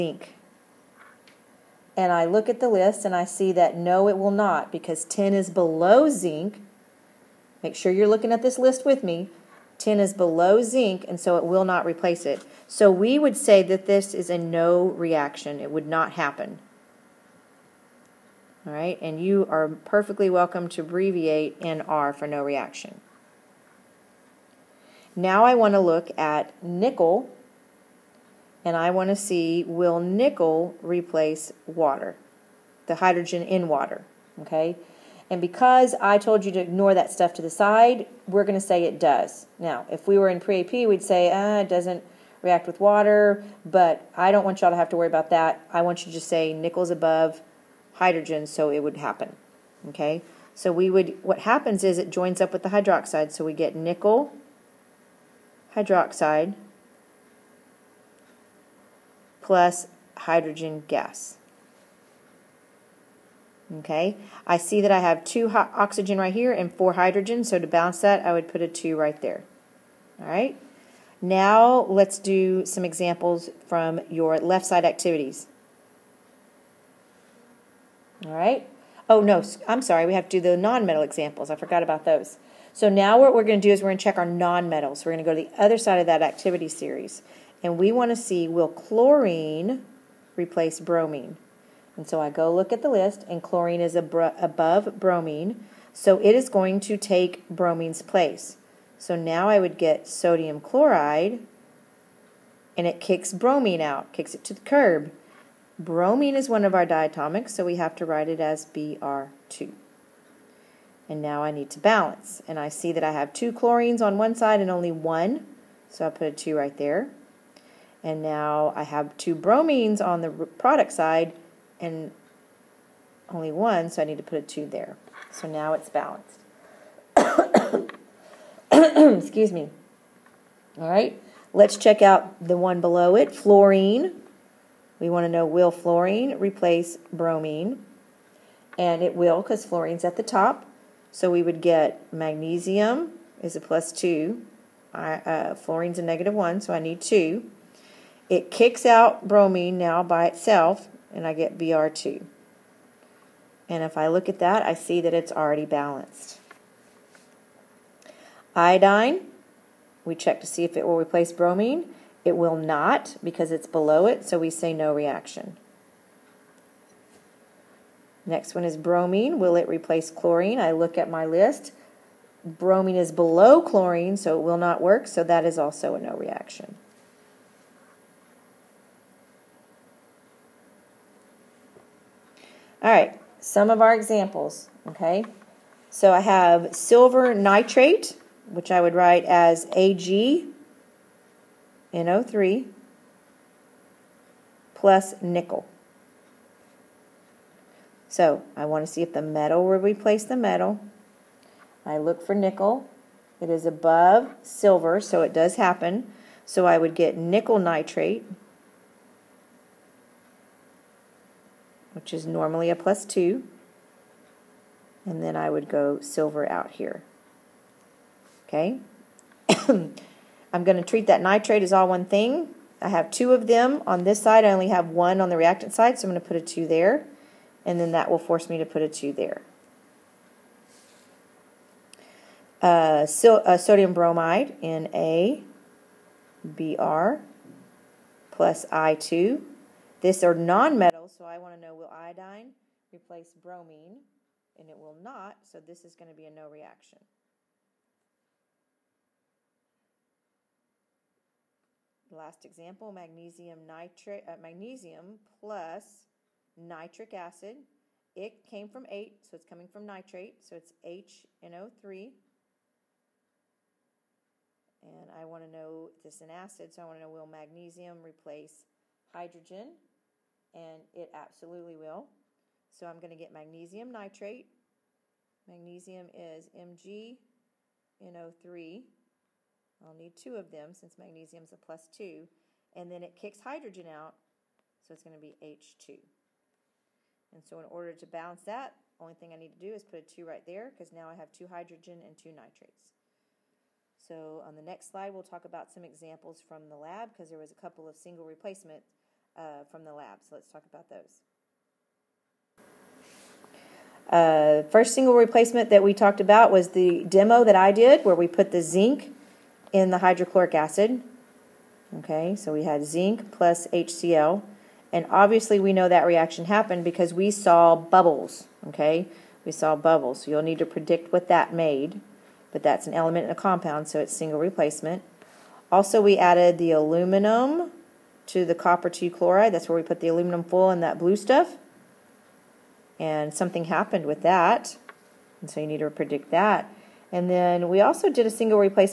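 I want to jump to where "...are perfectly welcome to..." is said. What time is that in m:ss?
0:19.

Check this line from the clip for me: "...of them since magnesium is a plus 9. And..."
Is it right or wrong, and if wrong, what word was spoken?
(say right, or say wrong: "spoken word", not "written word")
wrong: "2", not "9".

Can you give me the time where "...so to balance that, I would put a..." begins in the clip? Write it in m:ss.
1:07.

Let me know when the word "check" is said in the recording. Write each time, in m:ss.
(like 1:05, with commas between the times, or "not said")
1:24, 2:11, 2:40.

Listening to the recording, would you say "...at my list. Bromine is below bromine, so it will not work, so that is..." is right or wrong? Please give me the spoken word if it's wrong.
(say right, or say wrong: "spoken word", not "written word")
wrong: "chlorine", not "bromine".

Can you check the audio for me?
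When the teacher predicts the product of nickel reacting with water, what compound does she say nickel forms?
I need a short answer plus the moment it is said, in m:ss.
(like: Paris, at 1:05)
nickel hydroxide, at 0:53.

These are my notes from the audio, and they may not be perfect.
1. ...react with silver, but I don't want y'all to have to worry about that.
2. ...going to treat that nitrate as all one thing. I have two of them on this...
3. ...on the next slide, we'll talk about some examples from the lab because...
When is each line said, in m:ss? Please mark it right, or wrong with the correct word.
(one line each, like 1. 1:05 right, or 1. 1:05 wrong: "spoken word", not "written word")
1. 0:42 wrong: "water", not "silver"
2. 3:40 right
3. 4:54 right.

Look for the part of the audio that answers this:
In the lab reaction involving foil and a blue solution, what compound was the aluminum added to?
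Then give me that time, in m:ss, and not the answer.
5:28.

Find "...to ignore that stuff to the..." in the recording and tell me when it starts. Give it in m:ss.
0:36.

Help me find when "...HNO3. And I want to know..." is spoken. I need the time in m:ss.
4:20.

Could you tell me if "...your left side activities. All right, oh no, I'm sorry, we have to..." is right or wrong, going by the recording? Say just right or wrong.
right.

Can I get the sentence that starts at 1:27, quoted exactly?
And we want to see, will chlorine replace bromine?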